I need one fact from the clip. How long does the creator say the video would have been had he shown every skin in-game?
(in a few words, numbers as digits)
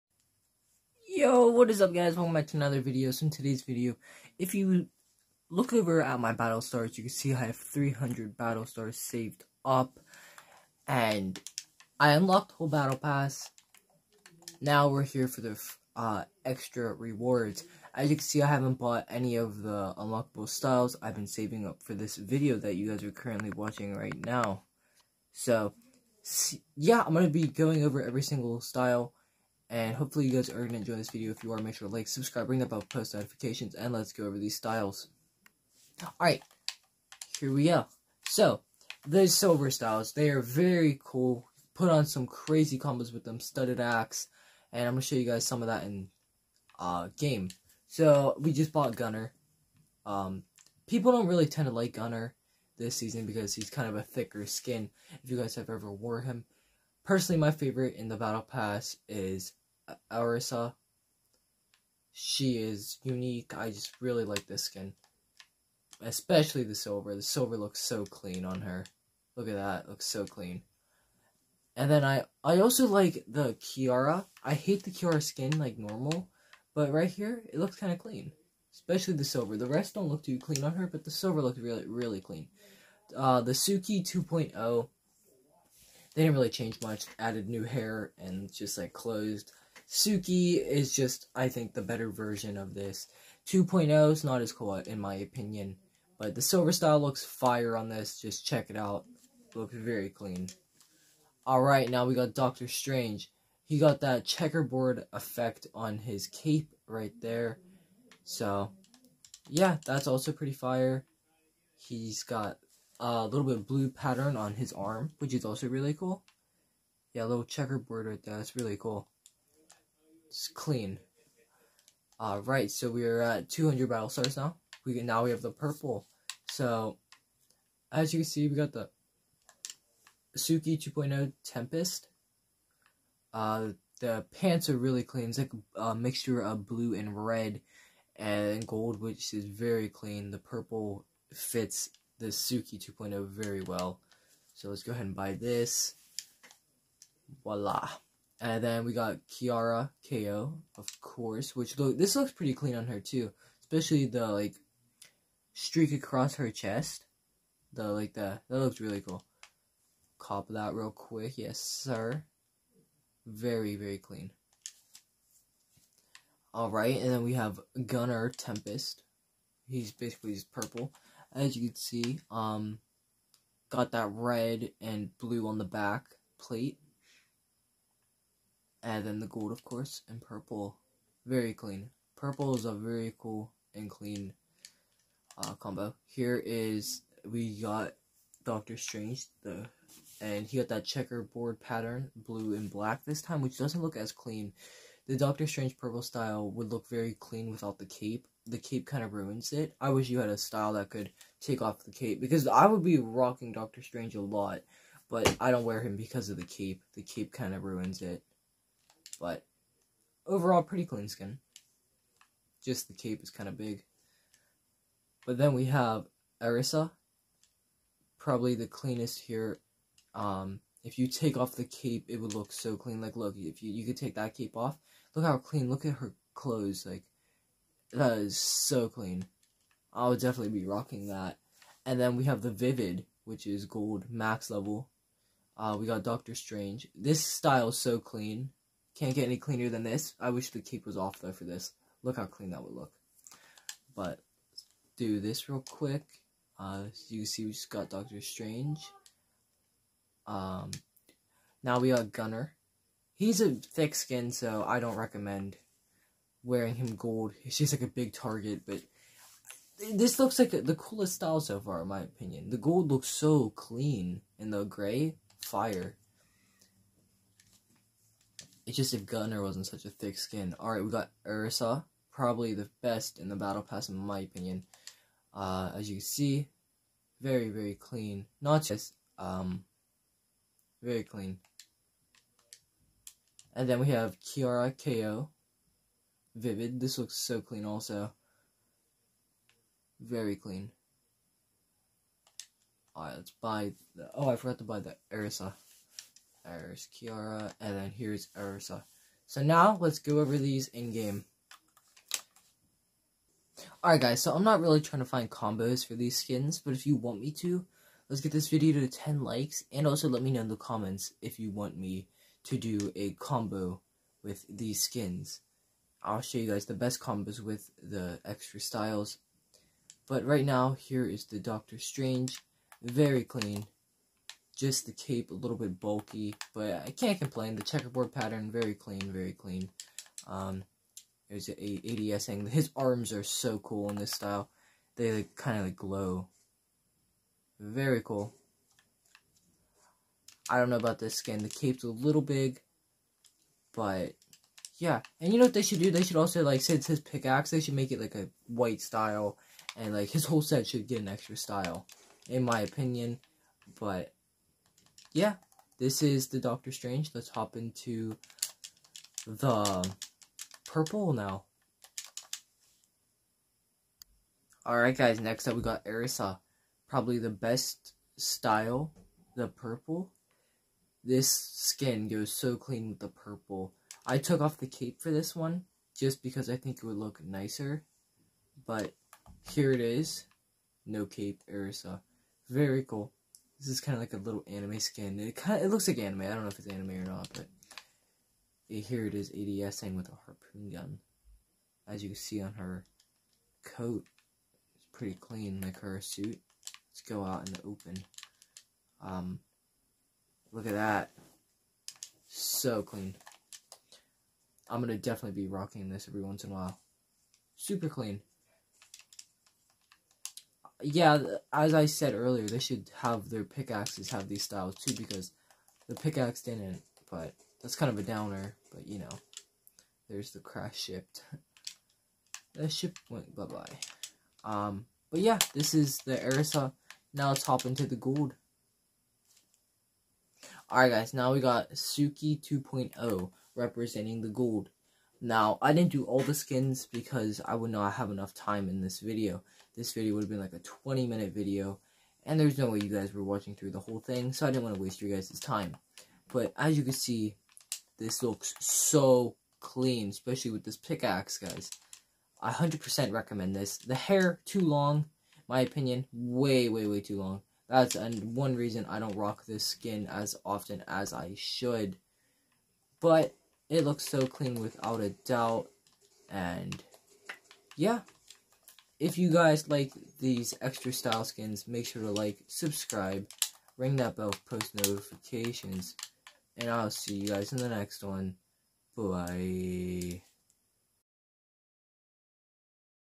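20 minutes.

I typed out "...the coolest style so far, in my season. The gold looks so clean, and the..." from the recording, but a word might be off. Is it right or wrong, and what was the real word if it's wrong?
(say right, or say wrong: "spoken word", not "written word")
wrong: "opinion", not "season".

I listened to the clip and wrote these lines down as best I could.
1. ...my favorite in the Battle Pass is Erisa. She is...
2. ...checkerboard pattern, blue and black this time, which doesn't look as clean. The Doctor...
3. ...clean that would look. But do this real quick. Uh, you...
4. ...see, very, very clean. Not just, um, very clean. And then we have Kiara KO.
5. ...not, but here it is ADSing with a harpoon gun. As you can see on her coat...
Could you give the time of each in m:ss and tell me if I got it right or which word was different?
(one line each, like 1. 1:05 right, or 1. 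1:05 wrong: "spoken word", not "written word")
1. 0:57 right
2. 3:10 right
3. 4:02 right
4. 4:35 right
5. 6:27 right.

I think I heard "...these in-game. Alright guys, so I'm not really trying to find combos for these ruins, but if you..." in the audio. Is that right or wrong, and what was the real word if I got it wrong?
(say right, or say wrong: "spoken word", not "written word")
wrong: "skins", not "ruins".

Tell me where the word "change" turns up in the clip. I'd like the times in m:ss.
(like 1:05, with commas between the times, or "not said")
1:26.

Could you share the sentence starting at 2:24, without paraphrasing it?
So let's go ahead and buy this.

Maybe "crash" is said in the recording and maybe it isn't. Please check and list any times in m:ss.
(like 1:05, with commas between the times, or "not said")
7:00.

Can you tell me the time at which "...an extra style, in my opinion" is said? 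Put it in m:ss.
5:50.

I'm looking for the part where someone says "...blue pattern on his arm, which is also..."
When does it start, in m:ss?
1:53.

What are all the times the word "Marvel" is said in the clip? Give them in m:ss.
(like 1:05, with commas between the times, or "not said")
not said.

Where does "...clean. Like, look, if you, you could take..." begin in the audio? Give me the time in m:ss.
3:42.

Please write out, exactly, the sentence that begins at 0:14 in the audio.
Now we're here for the uh, extra rewards.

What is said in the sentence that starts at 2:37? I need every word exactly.
The like the that looks really cool.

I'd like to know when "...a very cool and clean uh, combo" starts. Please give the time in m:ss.
3:02.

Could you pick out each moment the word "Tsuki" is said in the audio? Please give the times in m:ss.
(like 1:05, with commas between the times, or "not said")
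1:23, 1:29, 2:10, 2:22, 7:11.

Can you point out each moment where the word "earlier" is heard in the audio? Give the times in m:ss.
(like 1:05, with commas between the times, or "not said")
6:52.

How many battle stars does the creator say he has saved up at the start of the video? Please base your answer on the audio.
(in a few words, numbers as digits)
300.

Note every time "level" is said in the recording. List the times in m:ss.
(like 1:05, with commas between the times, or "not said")
3:54.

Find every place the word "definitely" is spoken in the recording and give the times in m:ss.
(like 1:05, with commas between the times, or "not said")
3:50, 6:44.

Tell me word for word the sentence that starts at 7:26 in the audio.
But as you can see, this looks so clean, especially with this pickaxe, guys.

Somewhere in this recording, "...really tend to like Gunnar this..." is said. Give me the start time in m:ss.
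0:51.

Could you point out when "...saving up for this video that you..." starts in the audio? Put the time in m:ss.
0:21.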